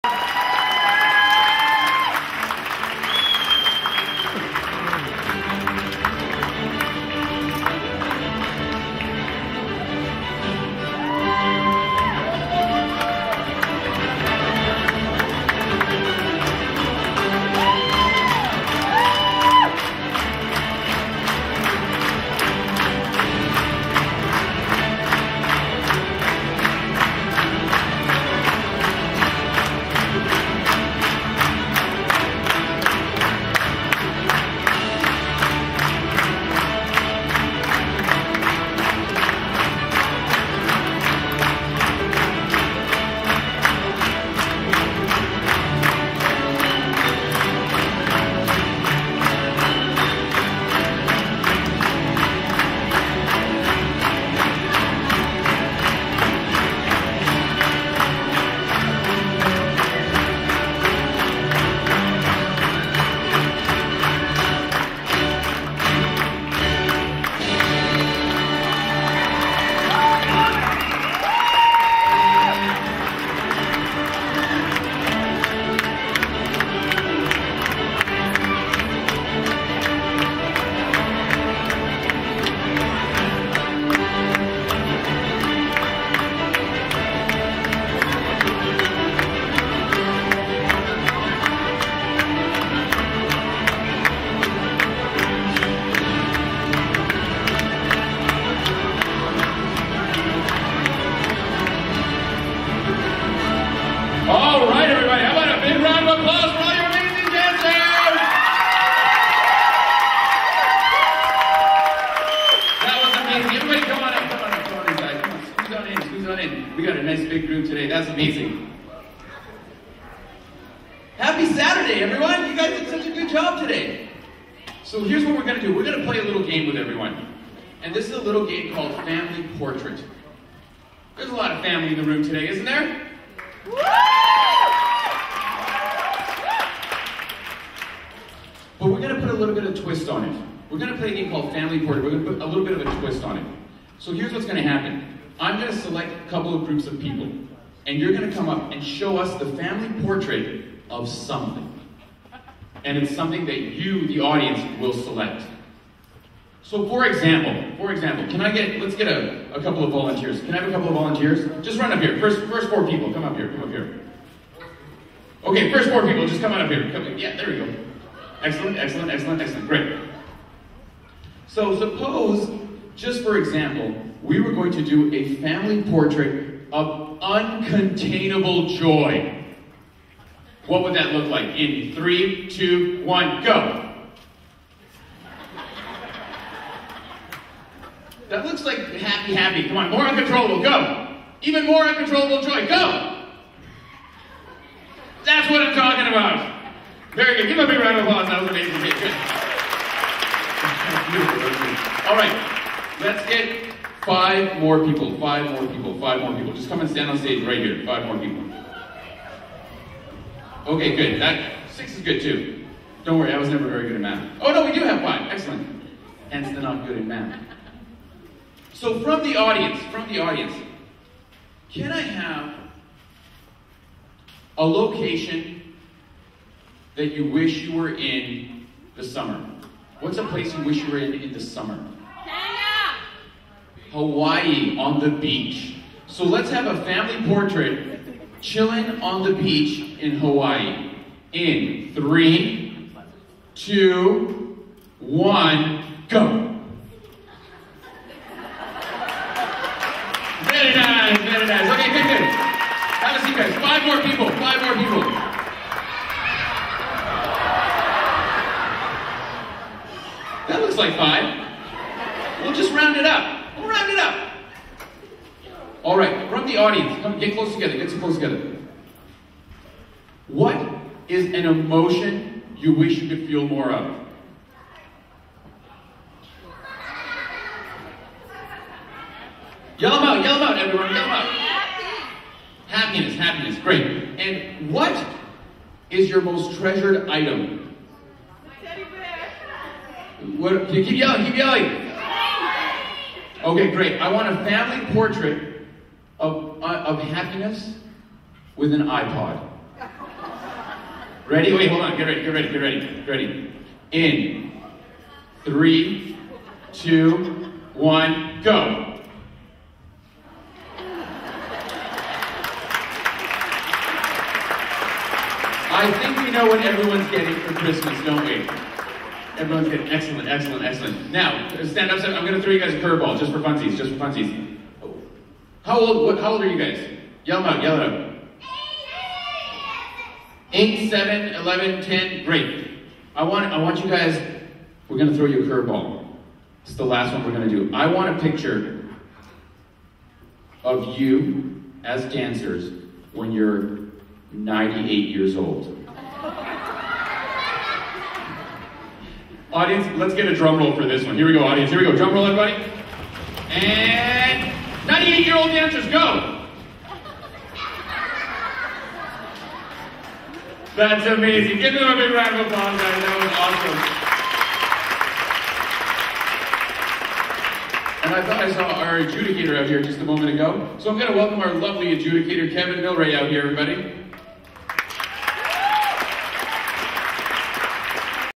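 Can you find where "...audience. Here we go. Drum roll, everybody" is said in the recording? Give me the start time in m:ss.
5:51.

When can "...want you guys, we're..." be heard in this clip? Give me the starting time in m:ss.
5:33.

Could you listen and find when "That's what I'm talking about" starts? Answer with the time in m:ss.
3:15.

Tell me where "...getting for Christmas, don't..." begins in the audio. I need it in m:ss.
5:17.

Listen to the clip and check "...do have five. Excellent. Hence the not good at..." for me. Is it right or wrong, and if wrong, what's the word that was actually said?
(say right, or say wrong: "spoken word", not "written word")
right.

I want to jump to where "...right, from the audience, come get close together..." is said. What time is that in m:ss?
4:25.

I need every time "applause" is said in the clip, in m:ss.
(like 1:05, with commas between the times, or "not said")
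3:18, 6:02.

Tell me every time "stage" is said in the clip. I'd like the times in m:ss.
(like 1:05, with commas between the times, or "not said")
3:27.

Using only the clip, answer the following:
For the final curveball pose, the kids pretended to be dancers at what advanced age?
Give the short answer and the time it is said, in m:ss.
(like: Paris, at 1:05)
98, at 5:44.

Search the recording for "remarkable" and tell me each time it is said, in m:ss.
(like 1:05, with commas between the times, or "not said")
not said.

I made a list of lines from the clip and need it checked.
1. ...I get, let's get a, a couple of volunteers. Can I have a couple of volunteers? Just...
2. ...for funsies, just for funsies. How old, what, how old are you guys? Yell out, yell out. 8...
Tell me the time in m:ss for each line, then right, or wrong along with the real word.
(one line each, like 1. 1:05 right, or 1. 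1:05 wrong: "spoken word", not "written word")
1. 2:38 right
2. 5:23 right.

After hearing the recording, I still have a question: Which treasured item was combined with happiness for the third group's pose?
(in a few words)
An iPod.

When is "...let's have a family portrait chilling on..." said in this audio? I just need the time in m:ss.
3:56.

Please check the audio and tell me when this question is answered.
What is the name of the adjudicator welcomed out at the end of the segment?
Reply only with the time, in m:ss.
6:12.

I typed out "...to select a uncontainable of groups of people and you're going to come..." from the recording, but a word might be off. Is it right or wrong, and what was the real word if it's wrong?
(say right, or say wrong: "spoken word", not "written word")
wrong: "couple", not "uncontainable".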